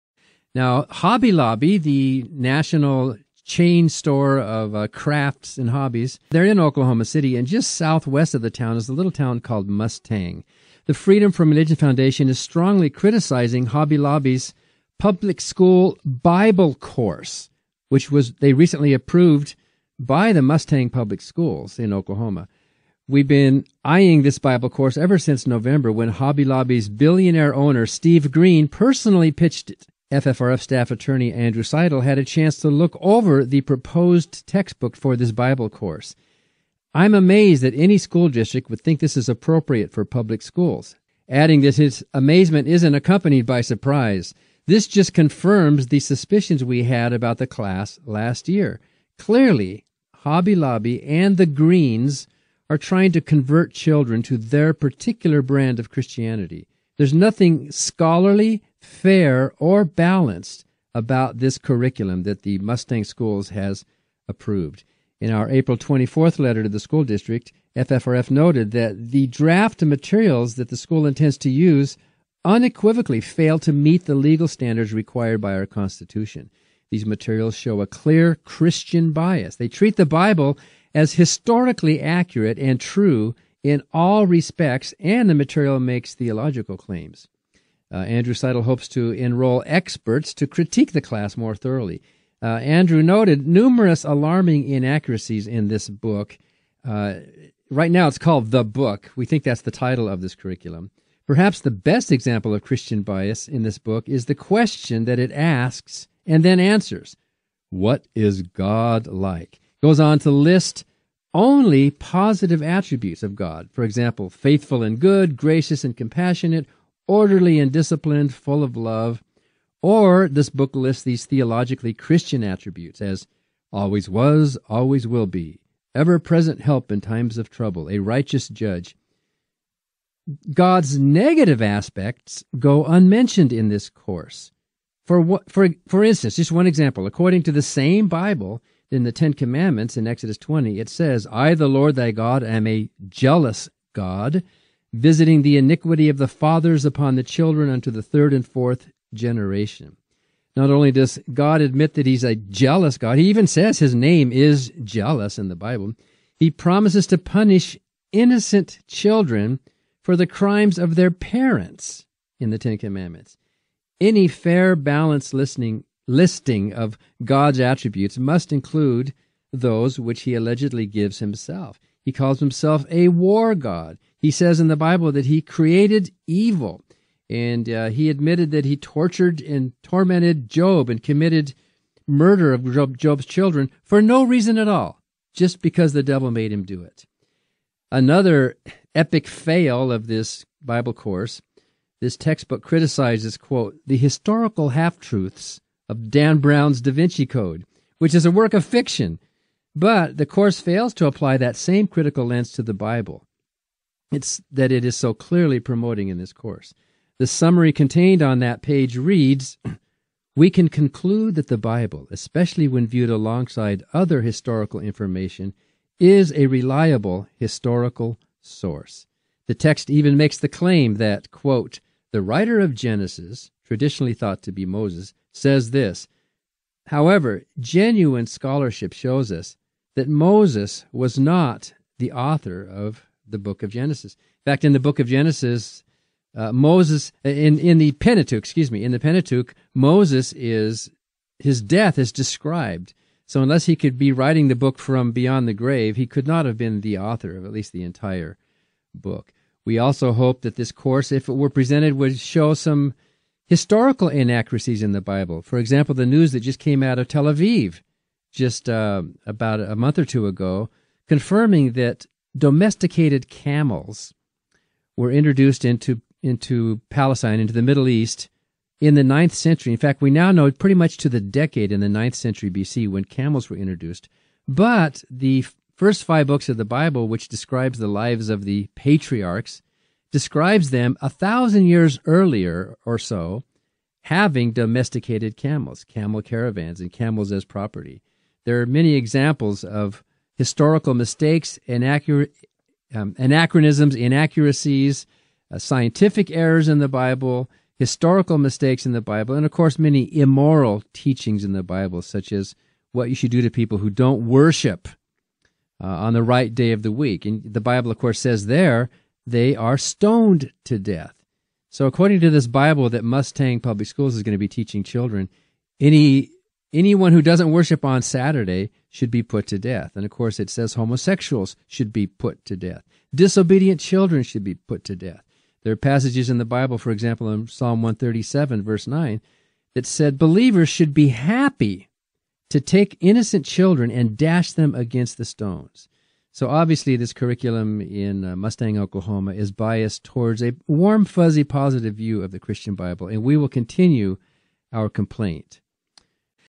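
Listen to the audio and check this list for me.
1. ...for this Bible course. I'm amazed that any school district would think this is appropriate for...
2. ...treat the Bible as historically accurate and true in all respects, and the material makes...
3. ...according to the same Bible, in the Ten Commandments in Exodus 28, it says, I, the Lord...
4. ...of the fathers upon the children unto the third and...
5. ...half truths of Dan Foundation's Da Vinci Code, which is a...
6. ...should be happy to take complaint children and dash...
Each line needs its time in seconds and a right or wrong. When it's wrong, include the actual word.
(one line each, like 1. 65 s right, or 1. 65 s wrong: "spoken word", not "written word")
1. 34 s right
2. 79 s right
3. 137 s wrong: "20", not "28"
4. 146 s right
5. 194 s wrong: "Brown", not "Foundation"
6. 330 s wrong: "innocent", not "complaint".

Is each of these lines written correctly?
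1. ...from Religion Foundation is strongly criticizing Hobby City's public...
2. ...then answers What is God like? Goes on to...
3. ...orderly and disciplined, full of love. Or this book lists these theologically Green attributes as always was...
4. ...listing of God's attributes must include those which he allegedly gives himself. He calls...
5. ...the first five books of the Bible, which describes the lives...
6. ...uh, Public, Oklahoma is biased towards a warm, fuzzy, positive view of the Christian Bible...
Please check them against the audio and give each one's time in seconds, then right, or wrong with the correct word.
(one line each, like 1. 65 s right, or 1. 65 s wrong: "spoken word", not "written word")
1. 11 s wrong: "Lobby", not "City"
2. 106 s right
3. 117 s wrong: "Christian", not "Green"
4. 166 s right
5. 275 s right
6. 338 s wrong: "Mustang", not "Public".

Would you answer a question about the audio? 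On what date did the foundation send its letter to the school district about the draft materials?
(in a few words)
April 24.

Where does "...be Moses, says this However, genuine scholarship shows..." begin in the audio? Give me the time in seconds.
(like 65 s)
224 s.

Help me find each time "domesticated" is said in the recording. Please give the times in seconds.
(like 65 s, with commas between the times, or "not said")
262 s, 284 s.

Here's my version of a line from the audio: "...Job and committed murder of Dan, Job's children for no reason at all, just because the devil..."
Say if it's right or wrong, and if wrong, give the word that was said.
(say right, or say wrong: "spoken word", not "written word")
wrong: "Job", not "Dan".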